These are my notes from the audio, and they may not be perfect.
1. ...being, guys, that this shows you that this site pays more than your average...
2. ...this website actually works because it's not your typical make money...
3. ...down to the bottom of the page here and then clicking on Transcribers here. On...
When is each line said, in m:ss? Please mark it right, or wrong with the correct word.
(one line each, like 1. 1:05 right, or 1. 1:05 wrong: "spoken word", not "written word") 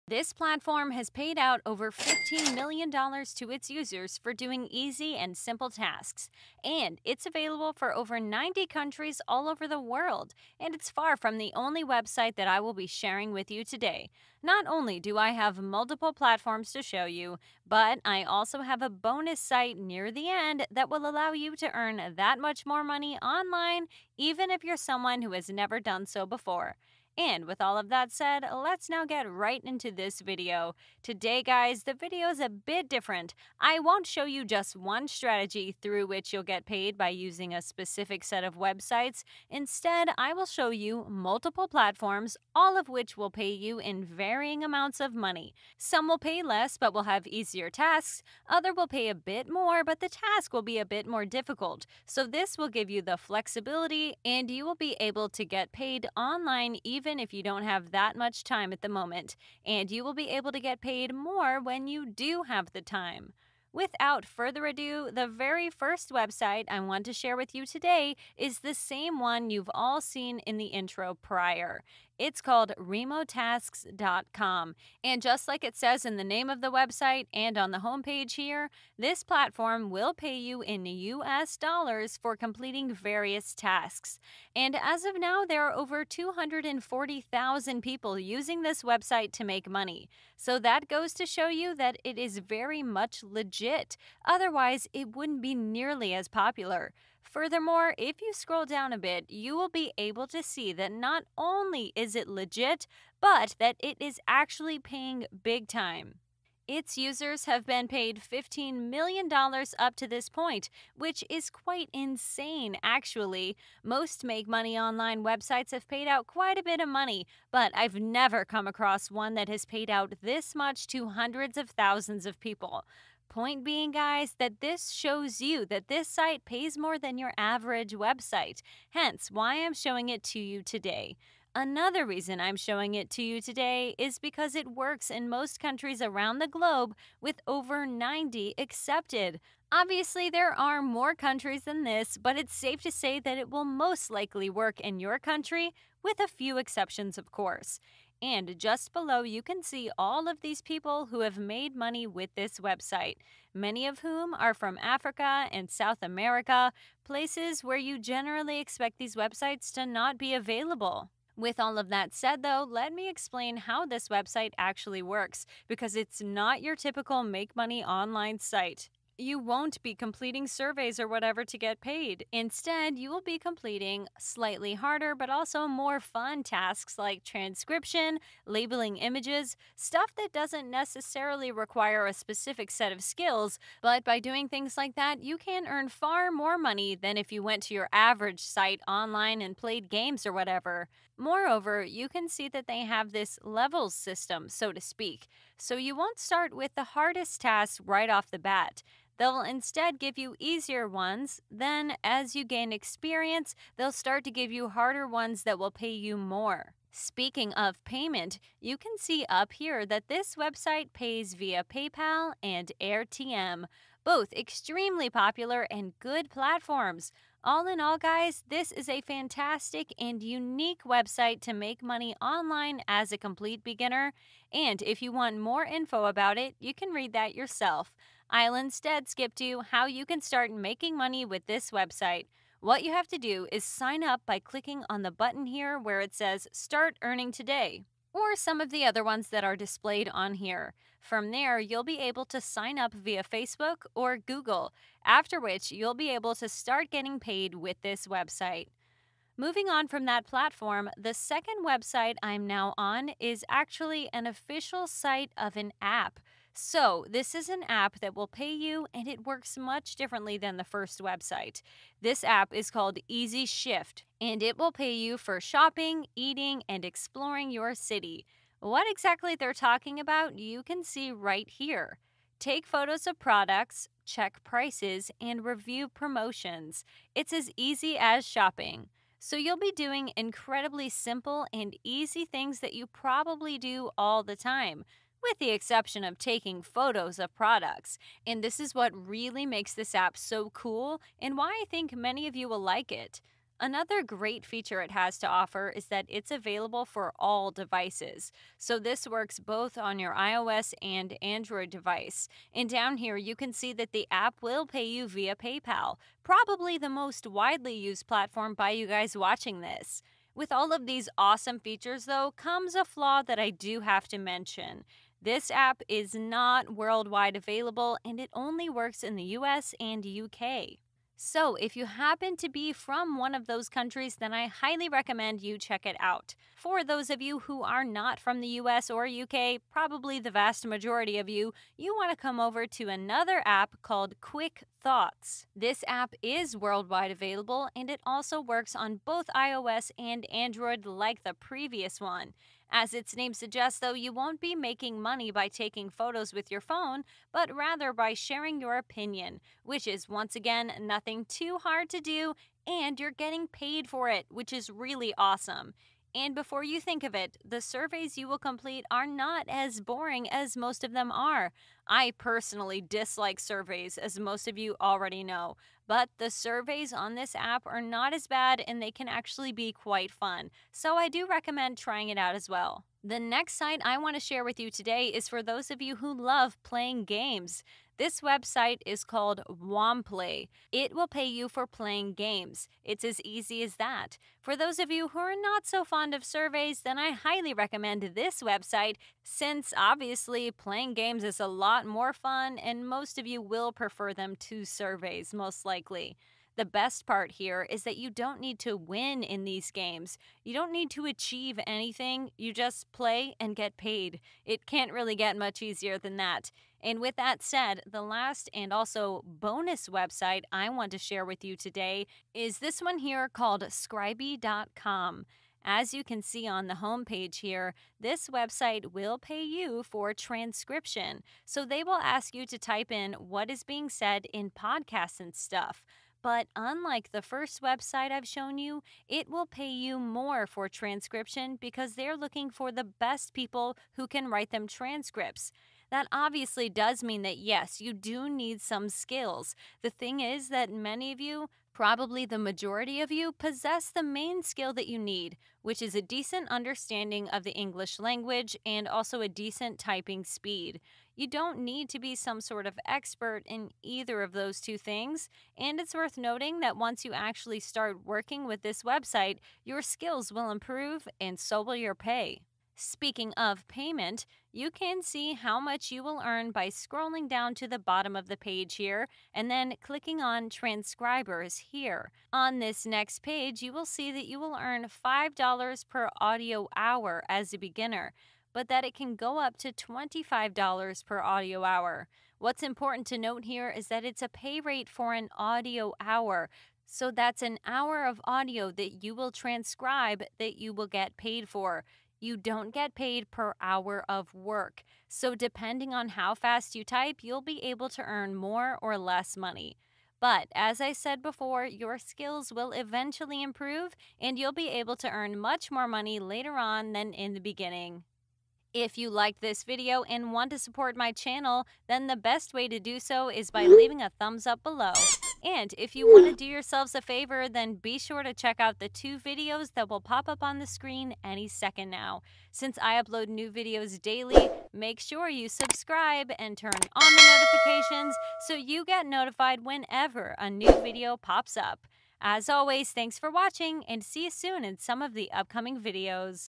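1. 2:03 right
2. 2:43 right
3. 7:47 right.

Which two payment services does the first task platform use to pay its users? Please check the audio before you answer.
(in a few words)
PayPal and AirTM.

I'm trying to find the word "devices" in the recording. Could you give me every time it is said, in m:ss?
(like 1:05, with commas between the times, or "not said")
4:57, 5:01.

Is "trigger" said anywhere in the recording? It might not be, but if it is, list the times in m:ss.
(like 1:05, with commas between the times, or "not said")
not said.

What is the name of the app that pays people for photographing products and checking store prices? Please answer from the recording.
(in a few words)
Easy Shift.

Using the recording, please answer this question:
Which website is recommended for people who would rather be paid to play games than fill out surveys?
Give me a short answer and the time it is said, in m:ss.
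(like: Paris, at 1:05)
Womplay, at 6:19.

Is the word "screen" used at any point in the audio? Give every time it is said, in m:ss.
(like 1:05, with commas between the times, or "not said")
8:40.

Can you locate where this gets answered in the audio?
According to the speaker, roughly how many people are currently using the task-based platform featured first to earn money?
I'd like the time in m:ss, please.
1:25.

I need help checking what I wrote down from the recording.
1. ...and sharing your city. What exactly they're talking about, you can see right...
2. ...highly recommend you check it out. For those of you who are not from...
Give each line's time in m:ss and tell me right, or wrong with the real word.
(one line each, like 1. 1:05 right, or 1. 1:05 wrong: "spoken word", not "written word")
1. 4:26 wrong: "exploring", not "sharing"
2. 5:24 right.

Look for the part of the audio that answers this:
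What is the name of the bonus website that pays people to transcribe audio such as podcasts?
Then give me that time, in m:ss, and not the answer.
6:53.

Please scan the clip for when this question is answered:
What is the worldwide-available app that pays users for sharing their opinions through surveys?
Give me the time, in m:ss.
5:34.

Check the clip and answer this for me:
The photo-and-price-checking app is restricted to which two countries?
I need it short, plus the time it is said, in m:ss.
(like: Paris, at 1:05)
US and UK, at 5:19.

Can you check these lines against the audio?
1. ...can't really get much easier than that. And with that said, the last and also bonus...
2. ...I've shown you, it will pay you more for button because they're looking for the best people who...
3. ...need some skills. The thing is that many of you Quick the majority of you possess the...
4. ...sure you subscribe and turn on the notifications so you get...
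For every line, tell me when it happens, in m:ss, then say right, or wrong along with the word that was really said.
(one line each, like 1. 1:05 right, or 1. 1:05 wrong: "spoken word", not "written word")
1. 6:44 right
2. 7:08 wrong: "transcription", not "button"
3. 7:18 wrong: "Probably", not "Quick"
4. 8:44 right.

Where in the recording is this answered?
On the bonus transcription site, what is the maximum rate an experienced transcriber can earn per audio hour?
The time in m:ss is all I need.
7:59.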